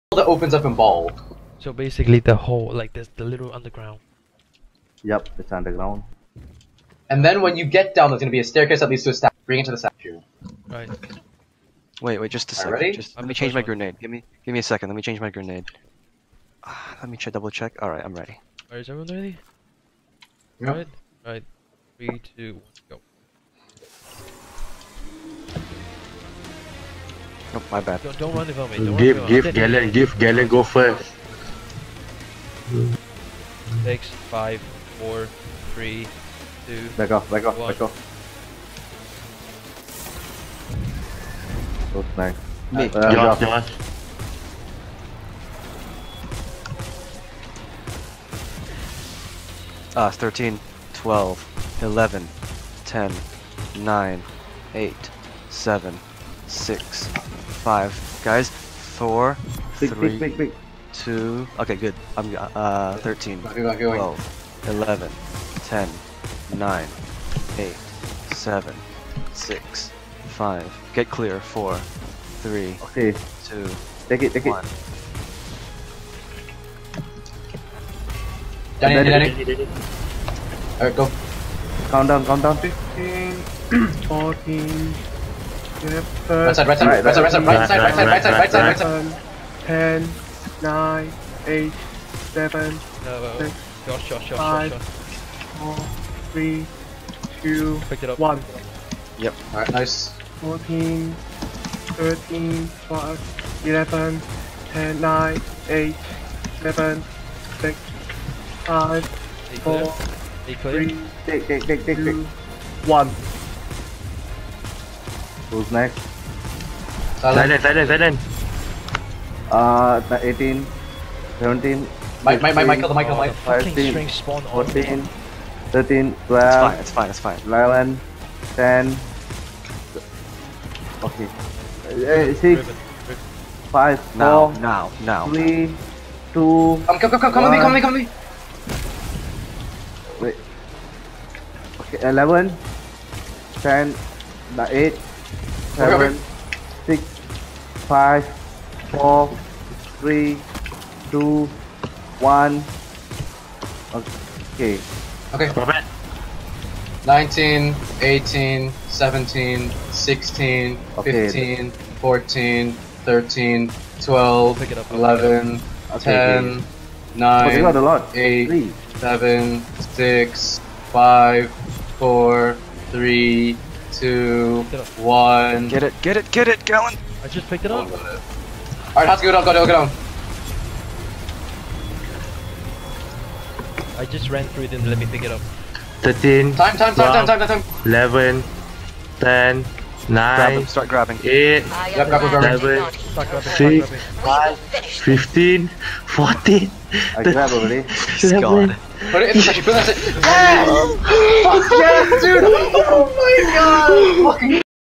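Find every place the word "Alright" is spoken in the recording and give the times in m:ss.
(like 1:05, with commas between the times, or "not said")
1:20, 2:57.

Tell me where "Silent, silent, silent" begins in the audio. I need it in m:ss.
1:57.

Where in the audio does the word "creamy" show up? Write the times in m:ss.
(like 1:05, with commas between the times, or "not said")
not said.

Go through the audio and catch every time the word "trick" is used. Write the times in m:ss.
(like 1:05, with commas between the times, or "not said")
not said.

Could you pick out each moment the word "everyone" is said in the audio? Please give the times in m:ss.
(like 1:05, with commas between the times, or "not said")
0:18.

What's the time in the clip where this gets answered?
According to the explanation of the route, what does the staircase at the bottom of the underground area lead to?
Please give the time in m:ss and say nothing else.
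0:09.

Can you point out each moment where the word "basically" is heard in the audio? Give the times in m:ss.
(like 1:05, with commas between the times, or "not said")
0:01.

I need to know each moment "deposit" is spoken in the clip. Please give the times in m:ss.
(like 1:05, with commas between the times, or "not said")
not said.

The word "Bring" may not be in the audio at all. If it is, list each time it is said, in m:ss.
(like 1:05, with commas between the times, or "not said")
0:09.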